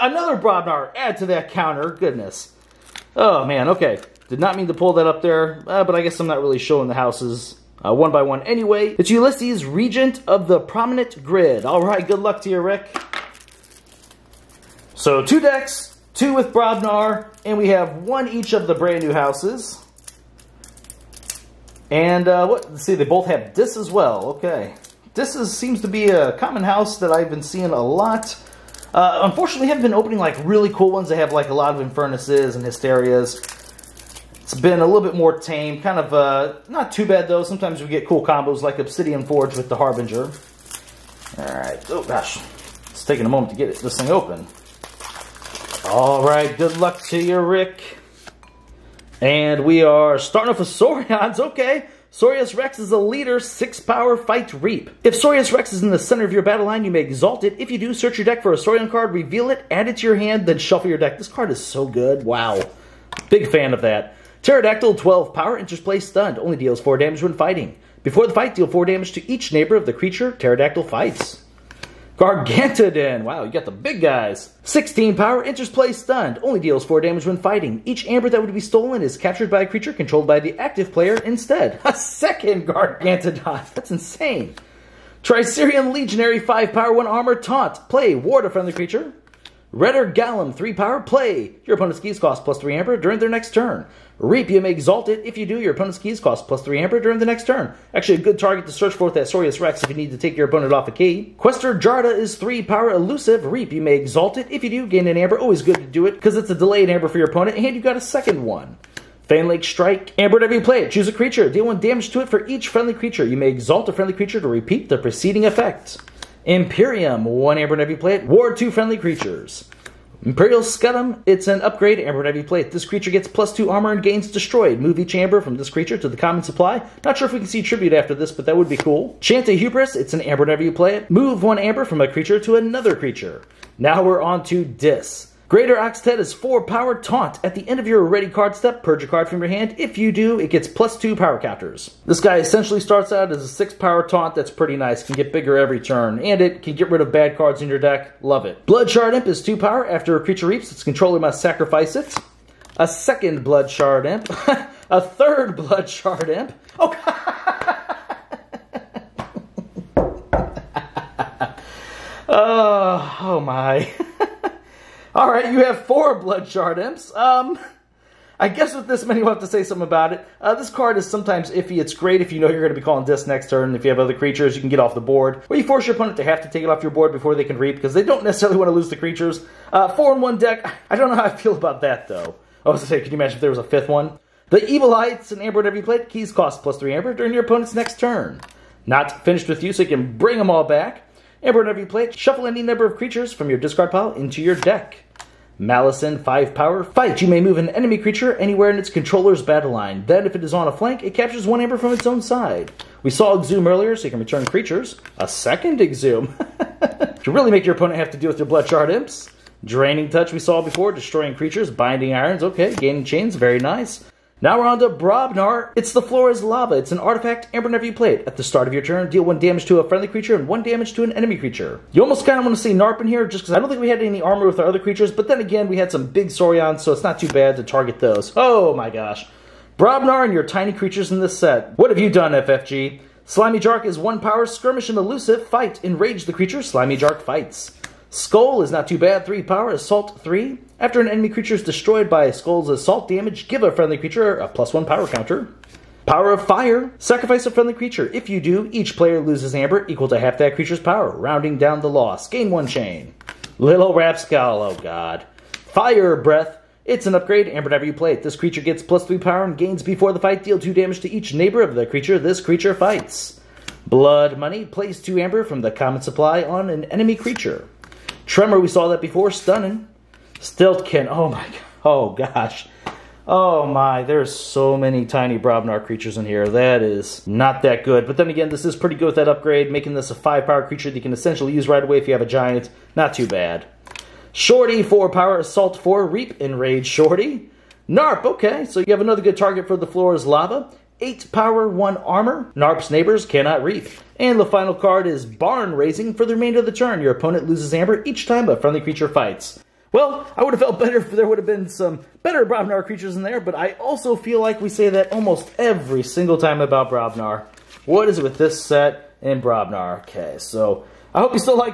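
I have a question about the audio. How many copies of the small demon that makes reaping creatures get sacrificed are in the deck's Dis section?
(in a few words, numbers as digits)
4.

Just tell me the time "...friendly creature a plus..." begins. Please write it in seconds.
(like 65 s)
243 s.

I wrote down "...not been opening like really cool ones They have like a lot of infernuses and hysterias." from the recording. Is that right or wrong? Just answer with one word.
right.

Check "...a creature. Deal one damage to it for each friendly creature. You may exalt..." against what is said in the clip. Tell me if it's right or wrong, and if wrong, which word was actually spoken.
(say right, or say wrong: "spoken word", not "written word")
right.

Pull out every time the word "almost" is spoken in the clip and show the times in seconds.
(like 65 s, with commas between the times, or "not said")
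222 s, 305 s.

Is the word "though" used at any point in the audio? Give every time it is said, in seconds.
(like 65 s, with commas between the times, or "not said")
37 s, 182 s.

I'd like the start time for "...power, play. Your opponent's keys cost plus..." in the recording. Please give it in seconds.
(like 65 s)
90 s.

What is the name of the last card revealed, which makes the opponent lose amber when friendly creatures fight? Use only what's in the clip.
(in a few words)
Barn Raising.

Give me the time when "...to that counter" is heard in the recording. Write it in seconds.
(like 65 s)
1 s.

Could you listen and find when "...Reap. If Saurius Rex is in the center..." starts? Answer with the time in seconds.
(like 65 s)
54 s.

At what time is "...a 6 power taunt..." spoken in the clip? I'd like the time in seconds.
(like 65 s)
143 s.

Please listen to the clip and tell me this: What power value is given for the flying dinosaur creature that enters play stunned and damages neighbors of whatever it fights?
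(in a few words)
12.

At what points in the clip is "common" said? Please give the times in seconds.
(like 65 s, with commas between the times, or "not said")
26 s, 126 s, 265 s.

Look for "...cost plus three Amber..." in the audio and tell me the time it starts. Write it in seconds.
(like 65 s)
186 s.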